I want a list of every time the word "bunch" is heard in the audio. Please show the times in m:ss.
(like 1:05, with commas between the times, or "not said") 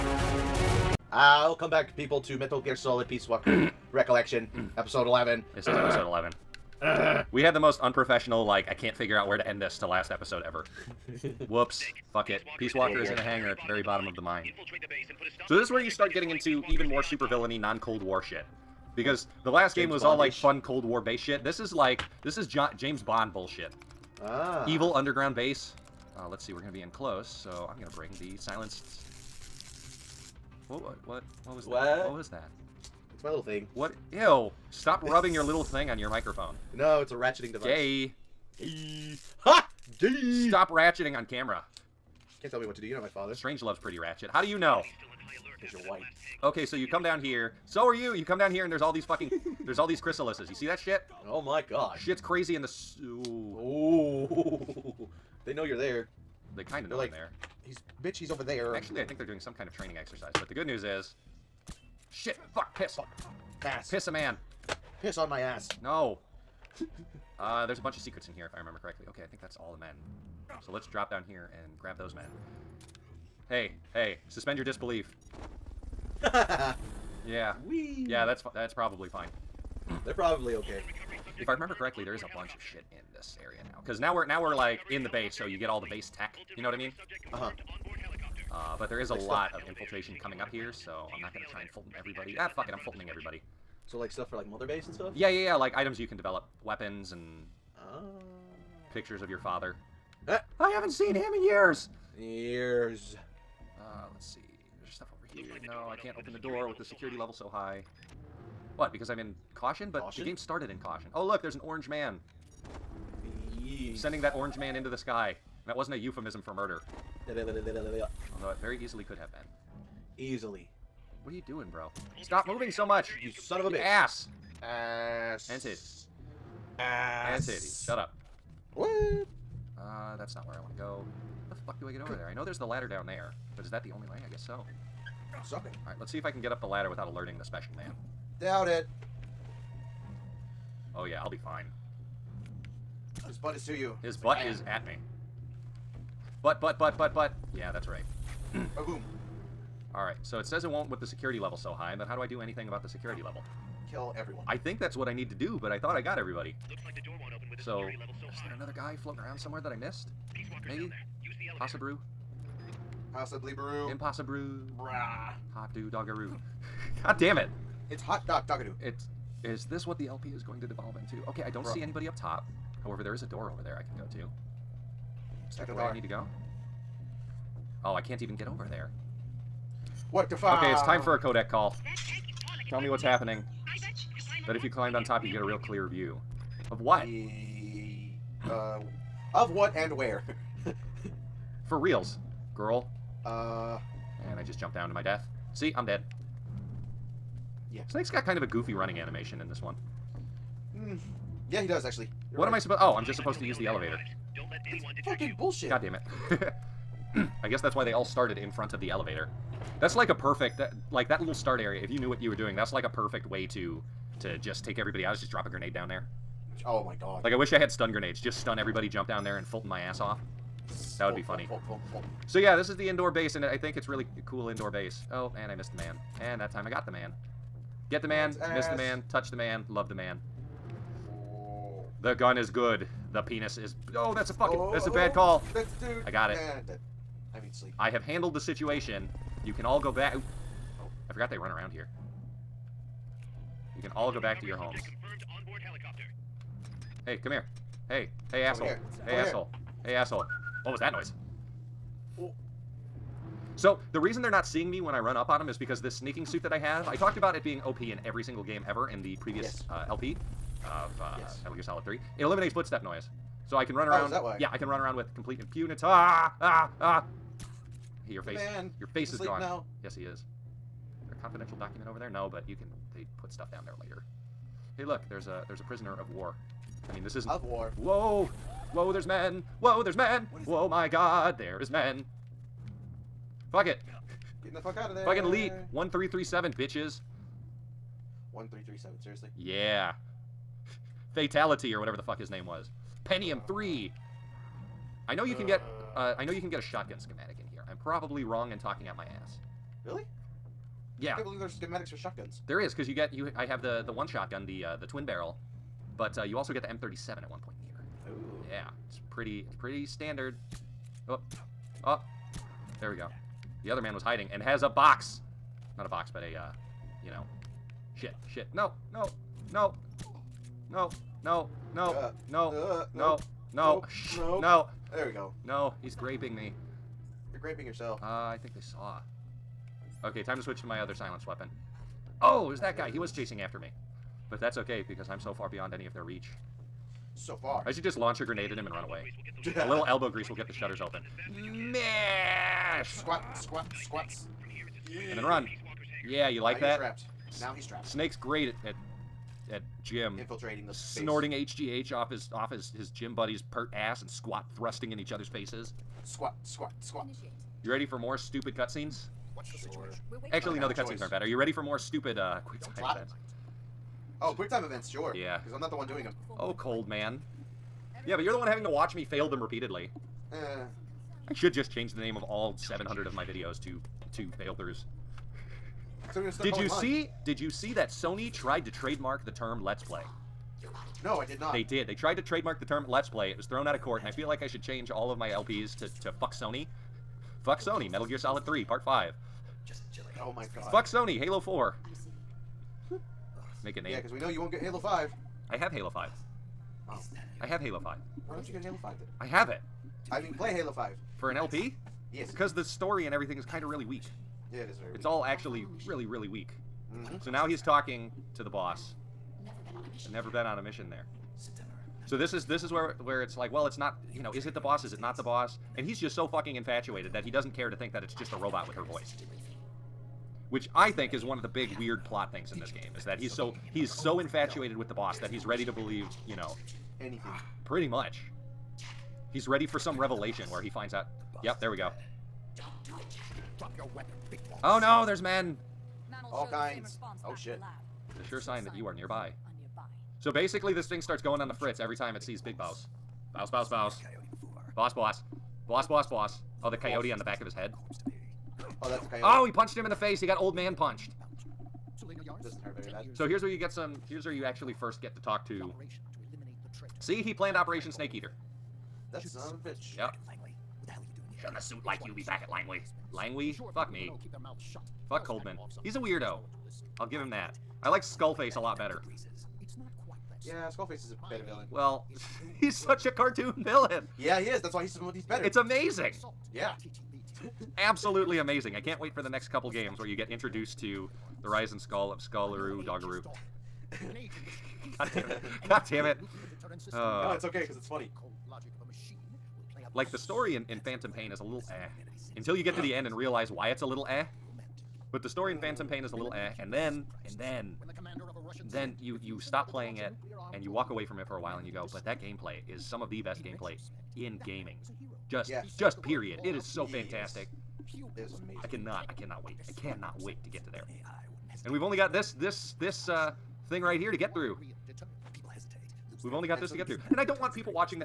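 1:07, 1:22.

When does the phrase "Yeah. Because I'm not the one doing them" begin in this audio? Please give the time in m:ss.
6:05.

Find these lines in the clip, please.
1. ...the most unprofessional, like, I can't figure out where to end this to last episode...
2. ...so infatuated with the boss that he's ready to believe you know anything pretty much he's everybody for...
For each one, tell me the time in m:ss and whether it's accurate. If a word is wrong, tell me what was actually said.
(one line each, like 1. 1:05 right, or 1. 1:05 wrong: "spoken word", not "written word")
1. 0:07 right
2. 7:03 wrong: "ready", not "everybody".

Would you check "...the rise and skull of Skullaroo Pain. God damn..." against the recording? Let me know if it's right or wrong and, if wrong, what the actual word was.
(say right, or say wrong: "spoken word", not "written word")
wrong: "Doggeroo", not "Pain".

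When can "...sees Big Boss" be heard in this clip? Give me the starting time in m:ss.
7:22.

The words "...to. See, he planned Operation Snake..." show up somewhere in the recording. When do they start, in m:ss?
7:35.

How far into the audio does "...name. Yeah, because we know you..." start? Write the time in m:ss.
6:33.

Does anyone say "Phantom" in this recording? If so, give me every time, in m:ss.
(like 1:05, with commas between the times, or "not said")
8:10, 8:15.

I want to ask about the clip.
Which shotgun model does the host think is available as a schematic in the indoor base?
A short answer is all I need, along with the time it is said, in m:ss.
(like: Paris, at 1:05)
M37, at 5:06.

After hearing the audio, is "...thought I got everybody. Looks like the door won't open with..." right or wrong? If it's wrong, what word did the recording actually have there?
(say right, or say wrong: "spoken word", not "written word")
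right.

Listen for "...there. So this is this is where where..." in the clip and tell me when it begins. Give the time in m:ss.
6:50.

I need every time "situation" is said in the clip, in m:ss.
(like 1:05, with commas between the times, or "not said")
3:58, 6:00.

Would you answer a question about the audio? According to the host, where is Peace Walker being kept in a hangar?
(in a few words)
the mine.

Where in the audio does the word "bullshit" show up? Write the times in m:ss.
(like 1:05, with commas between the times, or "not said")
0:23, 3:25.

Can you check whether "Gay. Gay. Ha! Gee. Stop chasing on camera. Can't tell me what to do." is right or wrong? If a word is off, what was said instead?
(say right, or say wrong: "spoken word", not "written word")
wrong: "ratcheting", not "chasing".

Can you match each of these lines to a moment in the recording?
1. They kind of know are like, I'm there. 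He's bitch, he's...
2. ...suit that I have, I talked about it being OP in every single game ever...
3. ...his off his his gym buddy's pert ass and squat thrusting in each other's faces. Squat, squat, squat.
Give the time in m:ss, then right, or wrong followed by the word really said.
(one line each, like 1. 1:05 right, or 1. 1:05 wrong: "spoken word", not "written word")
1. 0:56 right
2. 4:16 right
3. 5:52 right.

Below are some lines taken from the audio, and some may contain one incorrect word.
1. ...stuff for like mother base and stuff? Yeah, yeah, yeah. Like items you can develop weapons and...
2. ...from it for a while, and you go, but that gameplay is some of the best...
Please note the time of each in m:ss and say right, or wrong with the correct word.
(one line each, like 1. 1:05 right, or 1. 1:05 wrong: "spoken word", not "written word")
1. 1:34 right
2. 8:21 right.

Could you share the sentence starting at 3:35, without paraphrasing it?
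Is just drop a grenade down there.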